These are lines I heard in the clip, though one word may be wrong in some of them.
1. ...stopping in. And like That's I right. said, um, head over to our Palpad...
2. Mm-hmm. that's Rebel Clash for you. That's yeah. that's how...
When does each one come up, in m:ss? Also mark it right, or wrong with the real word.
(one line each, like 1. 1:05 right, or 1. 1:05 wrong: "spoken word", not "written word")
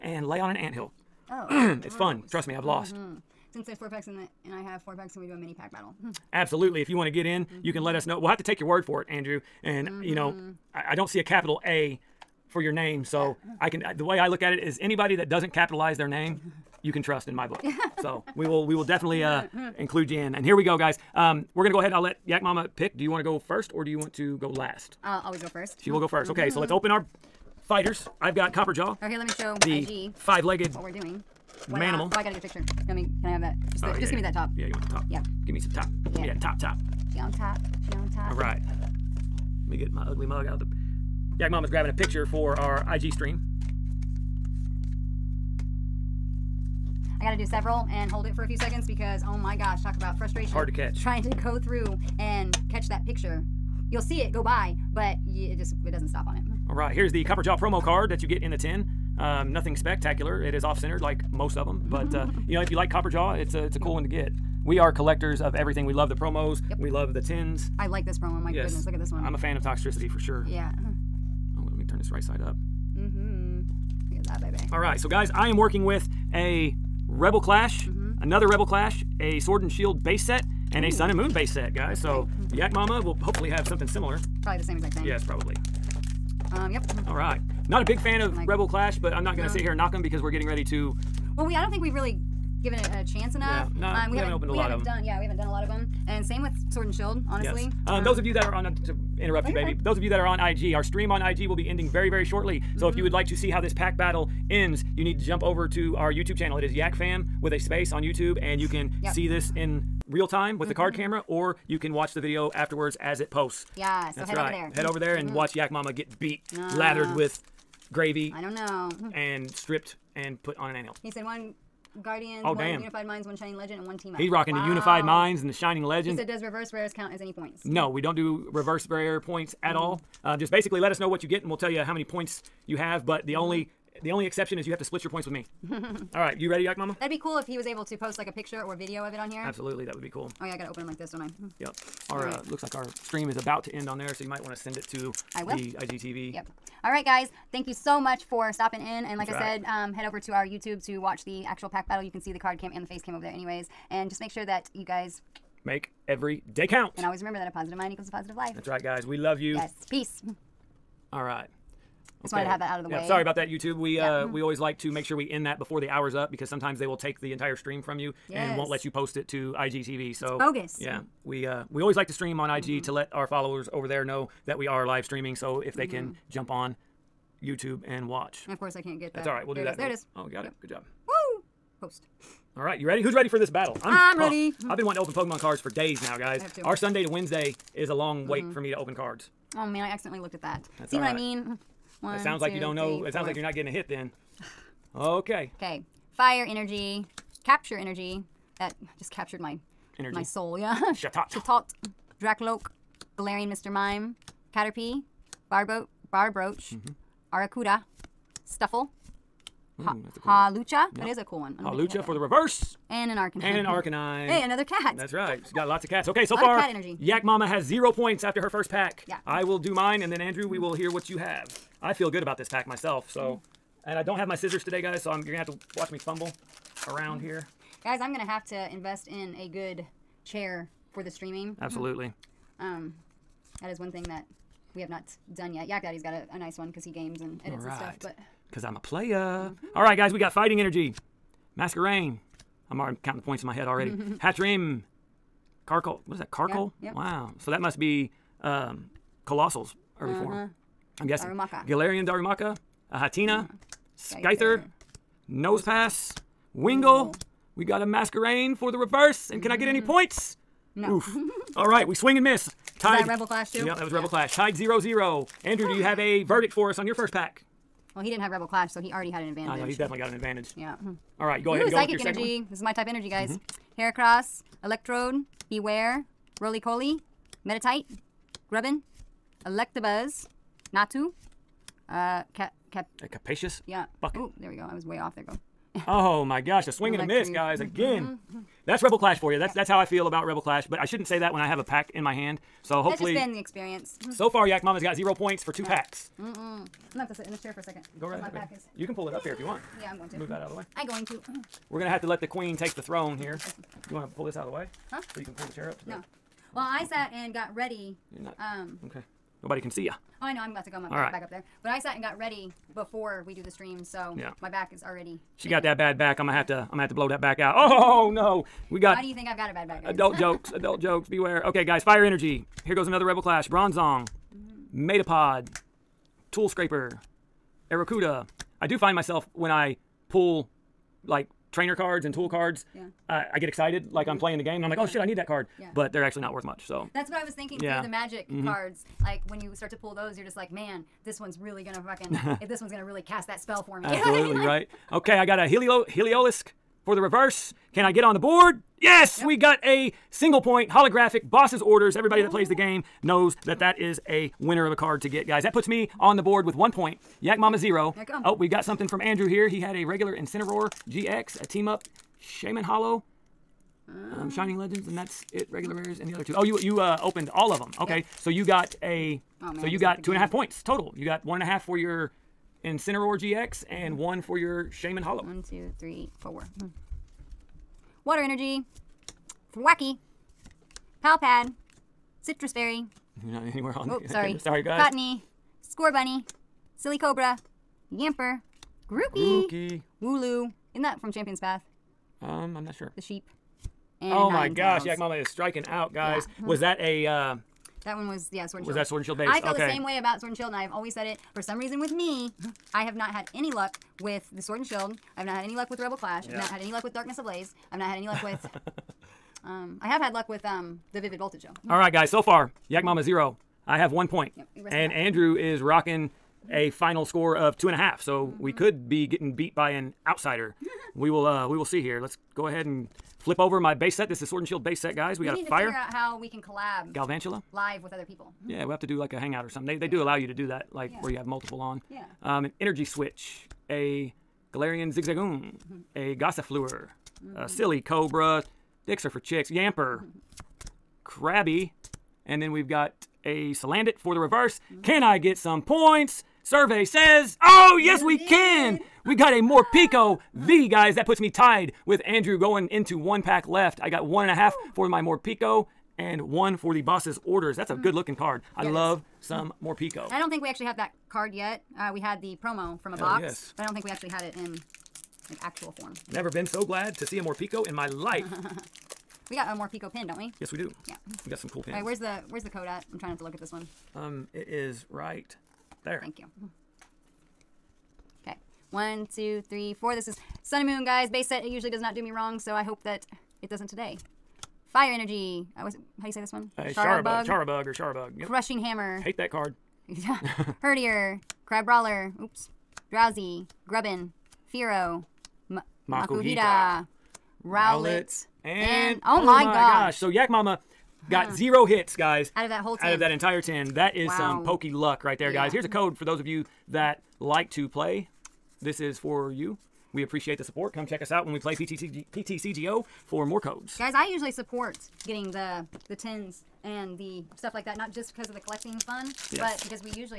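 1. 2:28 wrong: "YouTube", not "Palpad"
2. 4:48 right.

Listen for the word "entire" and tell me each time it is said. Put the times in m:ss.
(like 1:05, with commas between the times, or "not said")
2:47, 8:23.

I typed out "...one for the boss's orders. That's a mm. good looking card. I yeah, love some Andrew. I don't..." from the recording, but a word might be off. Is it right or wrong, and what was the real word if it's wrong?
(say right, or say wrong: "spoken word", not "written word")
wrong: "Morpeko", not "Andrew".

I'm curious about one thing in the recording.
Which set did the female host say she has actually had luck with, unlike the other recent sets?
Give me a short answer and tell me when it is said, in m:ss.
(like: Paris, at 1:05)
Vivid Voltage, at 6:51.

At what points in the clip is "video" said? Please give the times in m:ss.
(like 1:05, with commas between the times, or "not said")
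1:52, 2:18.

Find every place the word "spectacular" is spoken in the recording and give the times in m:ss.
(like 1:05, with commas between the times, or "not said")
0:59.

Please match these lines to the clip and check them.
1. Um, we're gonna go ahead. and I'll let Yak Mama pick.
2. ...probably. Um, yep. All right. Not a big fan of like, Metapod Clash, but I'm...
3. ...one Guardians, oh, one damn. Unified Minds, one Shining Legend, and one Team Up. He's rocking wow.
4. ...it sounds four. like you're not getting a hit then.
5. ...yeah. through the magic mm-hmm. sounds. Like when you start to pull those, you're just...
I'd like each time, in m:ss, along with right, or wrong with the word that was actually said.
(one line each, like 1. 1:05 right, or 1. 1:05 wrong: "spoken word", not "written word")
1. 0:21 right
2. 1:25 wrong: "Rebel", not "Metapod"
3. 2:01 right
4. 3:13 right
5. 5:37 wrong: "cards", not "sounds".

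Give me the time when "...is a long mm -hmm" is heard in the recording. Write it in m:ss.
3:07.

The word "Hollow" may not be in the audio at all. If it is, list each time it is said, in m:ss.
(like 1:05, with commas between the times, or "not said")
6:02, 6:15.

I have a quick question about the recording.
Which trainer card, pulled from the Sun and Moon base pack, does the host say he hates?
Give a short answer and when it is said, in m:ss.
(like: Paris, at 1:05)
Crushing Hammer, at 8:08.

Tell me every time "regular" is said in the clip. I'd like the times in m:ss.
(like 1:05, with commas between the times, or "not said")
5:59, 6:05.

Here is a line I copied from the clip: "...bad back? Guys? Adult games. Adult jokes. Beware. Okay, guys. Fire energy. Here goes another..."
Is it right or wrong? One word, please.
wrong.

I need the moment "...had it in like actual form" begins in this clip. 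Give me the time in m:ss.
7:44.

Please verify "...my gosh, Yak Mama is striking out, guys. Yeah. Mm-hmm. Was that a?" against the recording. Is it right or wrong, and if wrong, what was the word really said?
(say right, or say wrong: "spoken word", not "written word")
right.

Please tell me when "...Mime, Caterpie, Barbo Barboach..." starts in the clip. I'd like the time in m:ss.
3:23.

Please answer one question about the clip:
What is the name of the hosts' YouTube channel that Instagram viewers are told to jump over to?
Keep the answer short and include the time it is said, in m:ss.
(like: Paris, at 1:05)
Yak Fam, at 1:46.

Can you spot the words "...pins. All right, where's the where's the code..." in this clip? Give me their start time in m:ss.
7:51.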